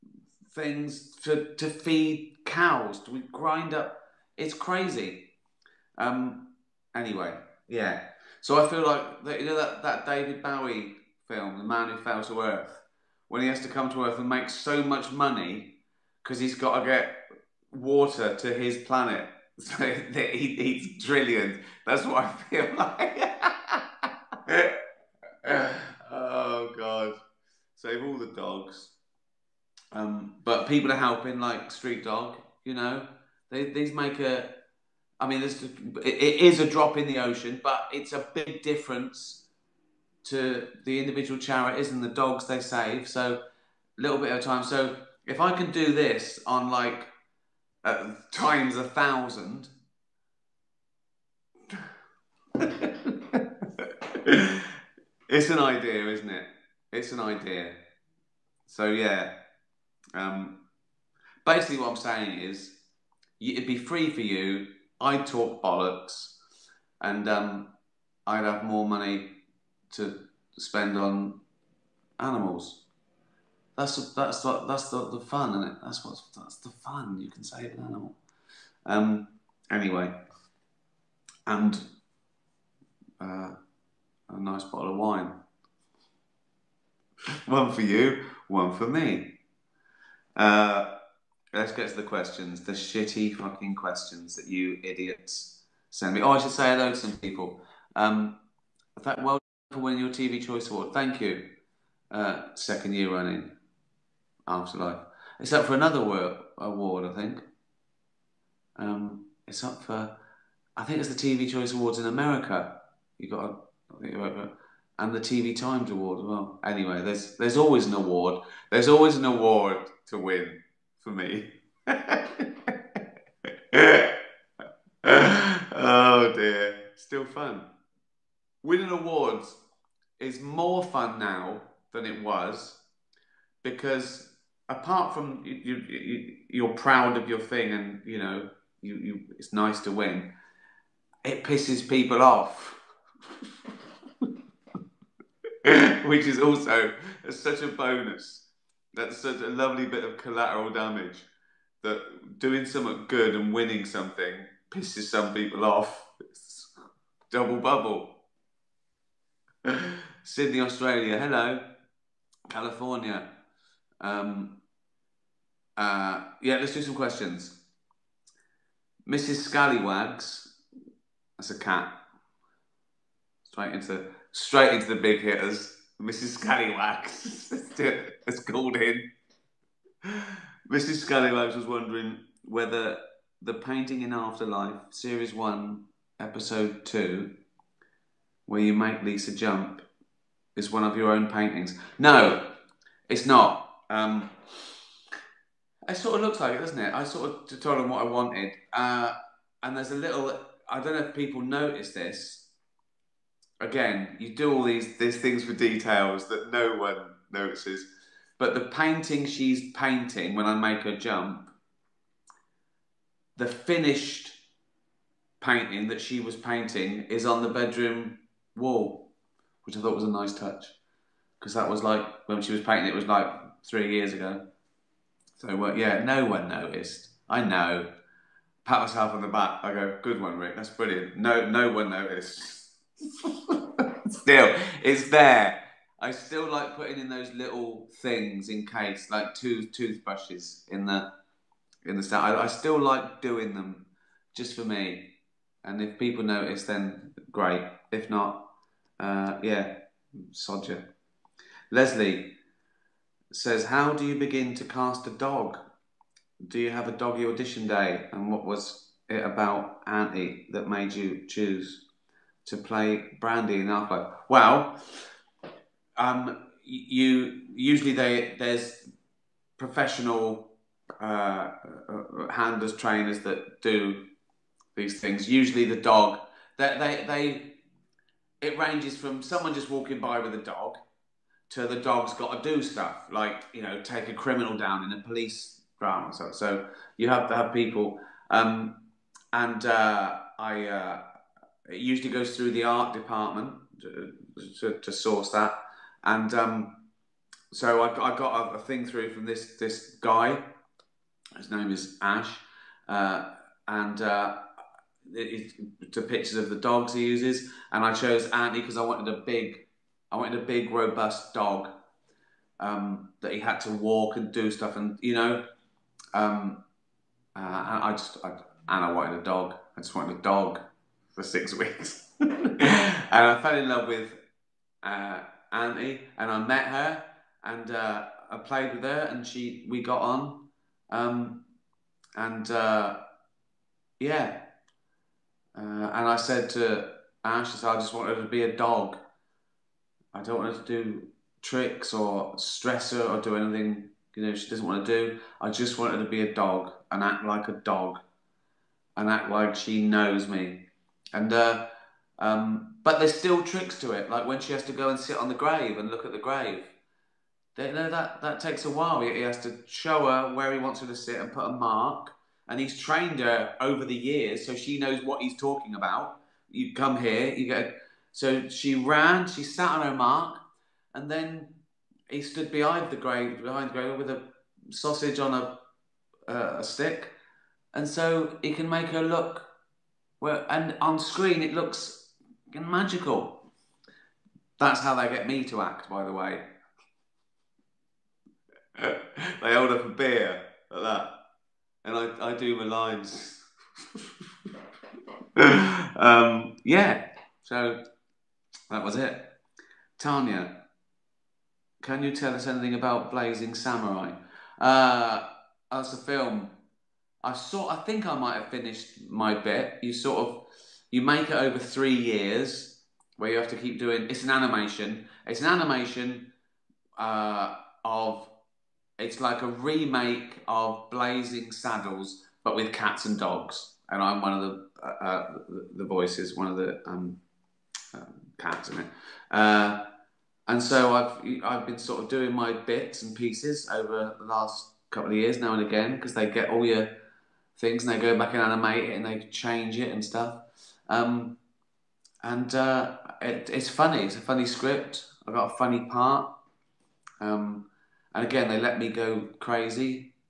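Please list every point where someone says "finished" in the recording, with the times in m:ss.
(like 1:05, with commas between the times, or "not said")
3:33, 6:48.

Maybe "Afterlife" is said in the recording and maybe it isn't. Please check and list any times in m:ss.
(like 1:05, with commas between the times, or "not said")
1:44, 3:04.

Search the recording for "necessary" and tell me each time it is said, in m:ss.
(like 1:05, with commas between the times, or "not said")
not said.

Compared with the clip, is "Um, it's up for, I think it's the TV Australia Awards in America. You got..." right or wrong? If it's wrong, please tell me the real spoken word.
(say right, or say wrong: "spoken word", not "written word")
wrong: "Choice", not "Australia".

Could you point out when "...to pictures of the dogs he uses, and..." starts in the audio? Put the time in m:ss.
5:05.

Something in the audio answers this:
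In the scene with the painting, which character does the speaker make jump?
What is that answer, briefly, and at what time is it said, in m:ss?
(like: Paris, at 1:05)
Lisa, at 3:09.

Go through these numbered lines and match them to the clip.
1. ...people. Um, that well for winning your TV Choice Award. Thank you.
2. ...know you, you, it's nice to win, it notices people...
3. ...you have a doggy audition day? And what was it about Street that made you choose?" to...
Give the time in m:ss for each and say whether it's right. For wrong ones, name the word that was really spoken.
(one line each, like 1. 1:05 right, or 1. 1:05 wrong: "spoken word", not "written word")
1. 1:37 right
2. 2:18 wrong: "pisses", not "notices"
3. 4:16 wrong: "Anti", not "Street".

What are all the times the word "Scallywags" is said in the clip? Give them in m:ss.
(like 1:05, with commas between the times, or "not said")
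2:49, 2:56, 3:01.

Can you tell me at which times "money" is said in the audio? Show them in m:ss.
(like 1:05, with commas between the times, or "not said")
0:15, 1:08.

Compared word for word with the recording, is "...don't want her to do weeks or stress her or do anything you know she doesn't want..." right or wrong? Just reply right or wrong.
wrong.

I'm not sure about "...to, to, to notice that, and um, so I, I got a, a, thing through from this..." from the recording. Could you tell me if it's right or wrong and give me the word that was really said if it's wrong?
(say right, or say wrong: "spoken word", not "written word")
wrong: "source", not "notice".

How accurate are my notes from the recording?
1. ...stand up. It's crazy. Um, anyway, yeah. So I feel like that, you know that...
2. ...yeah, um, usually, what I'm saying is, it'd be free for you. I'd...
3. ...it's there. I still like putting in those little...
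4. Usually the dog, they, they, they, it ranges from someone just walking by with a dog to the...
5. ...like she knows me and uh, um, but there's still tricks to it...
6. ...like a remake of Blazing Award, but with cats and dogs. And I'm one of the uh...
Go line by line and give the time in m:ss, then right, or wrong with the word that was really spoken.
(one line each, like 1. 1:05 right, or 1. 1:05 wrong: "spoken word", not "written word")
1. 0:03 wrong: "grind", not "stand"
2. 0:58 wrong: "basically", not "usually"
3. 3:54 right
4. 4:35 right
5. 5:49 right
6. 6:59 wrong: "Saddles", not "Award".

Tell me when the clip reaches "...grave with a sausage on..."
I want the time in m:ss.
6:13.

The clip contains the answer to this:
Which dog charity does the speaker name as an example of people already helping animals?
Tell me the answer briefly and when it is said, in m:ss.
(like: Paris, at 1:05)
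Street Dog, at 0:31.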